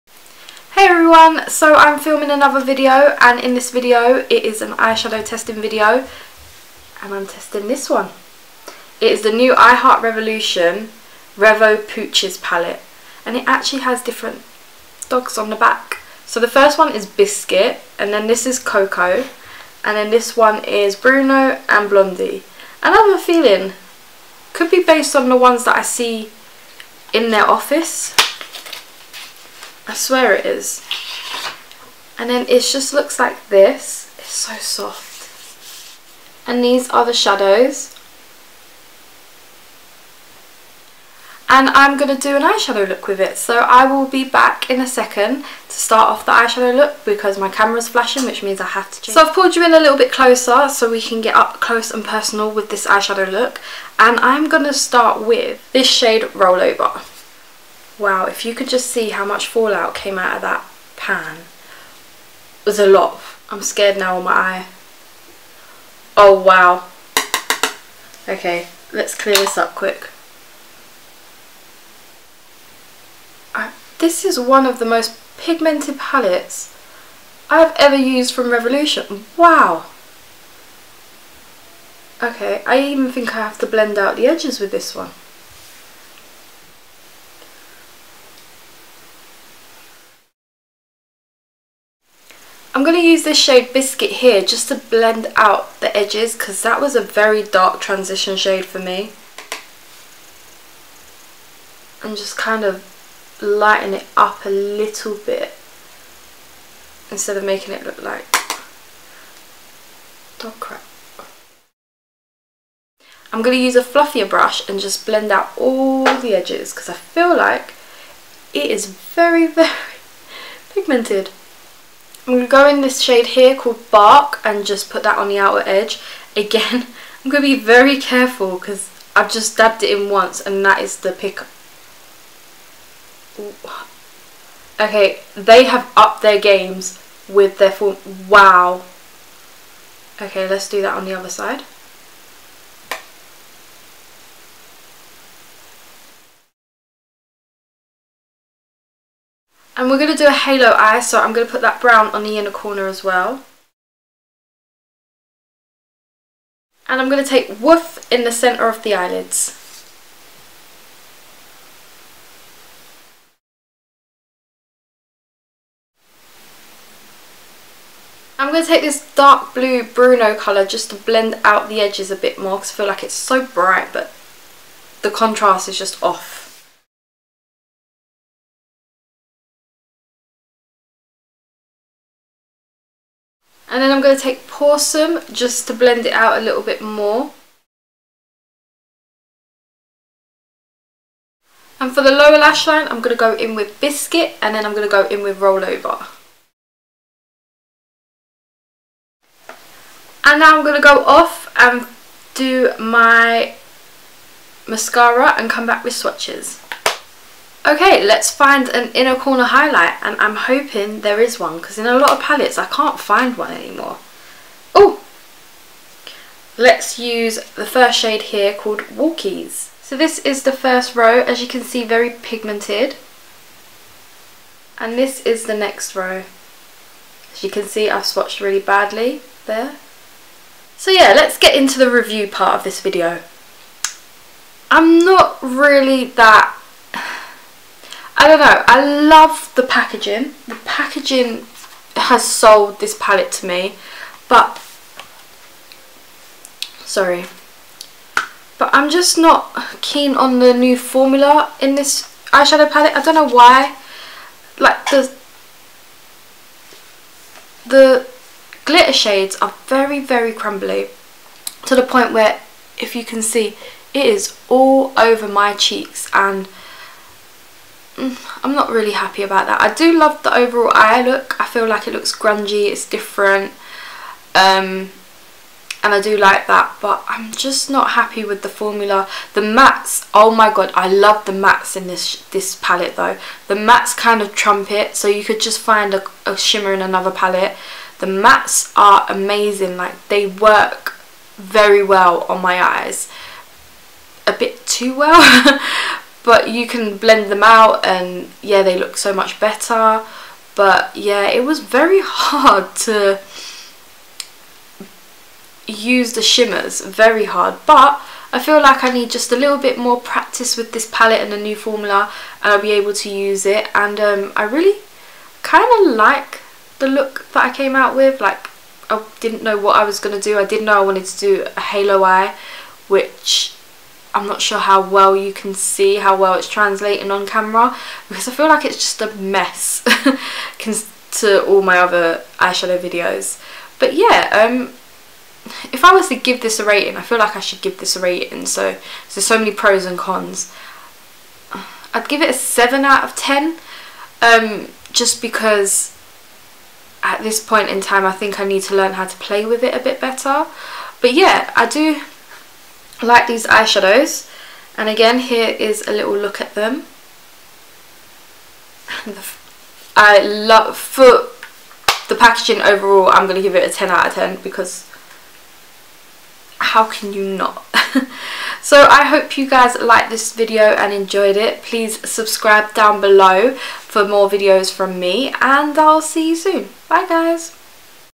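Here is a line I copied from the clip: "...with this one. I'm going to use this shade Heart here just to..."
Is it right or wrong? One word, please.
wrong.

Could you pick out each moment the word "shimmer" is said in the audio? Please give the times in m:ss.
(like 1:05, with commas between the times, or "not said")
4:46, 5:06.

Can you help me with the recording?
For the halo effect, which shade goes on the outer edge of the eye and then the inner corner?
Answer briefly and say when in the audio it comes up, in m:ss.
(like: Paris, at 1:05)
Bark, at 2:03.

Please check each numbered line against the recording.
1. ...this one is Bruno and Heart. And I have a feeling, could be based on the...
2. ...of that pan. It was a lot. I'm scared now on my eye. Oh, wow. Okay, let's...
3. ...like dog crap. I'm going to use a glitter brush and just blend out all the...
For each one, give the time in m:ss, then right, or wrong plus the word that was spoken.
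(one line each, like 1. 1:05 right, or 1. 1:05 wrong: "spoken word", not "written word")
1. 0:20 wrong: "Blondie", not "Heart"
2. 1:00 right
3. 1:48 wrong: "fluffier", not "glitter".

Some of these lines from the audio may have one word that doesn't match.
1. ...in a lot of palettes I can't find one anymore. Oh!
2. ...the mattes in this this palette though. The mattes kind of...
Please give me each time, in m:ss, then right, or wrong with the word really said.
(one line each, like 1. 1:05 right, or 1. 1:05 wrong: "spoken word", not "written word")
1. 3:31 right
2. 4:41 right.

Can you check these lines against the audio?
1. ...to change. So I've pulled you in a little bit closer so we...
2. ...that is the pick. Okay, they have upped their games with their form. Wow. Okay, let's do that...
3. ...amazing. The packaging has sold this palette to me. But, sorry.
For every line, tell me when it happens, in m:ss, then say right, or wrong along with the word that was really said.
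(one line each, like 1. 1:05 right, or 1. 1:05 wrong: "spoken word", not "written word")
1. 0:48 right
2. 2:10 right
3. 3:59 wrong: "packaging", not "amazing".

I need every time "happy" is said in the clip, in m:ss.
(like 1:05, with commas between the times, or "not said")
4:28, 4:37.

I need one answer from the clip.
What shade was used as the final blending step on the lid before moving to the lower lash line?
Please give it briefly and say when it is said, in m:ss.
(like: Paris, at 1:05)
Pawsome, at 3:04.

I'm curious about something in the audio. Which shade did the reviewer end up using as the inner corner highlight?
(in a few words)
Walkies.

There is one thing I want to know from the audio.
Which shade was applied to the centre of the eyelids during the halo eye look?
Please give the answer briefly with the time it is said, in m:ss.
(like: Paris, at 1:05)
Woof, at 2:37.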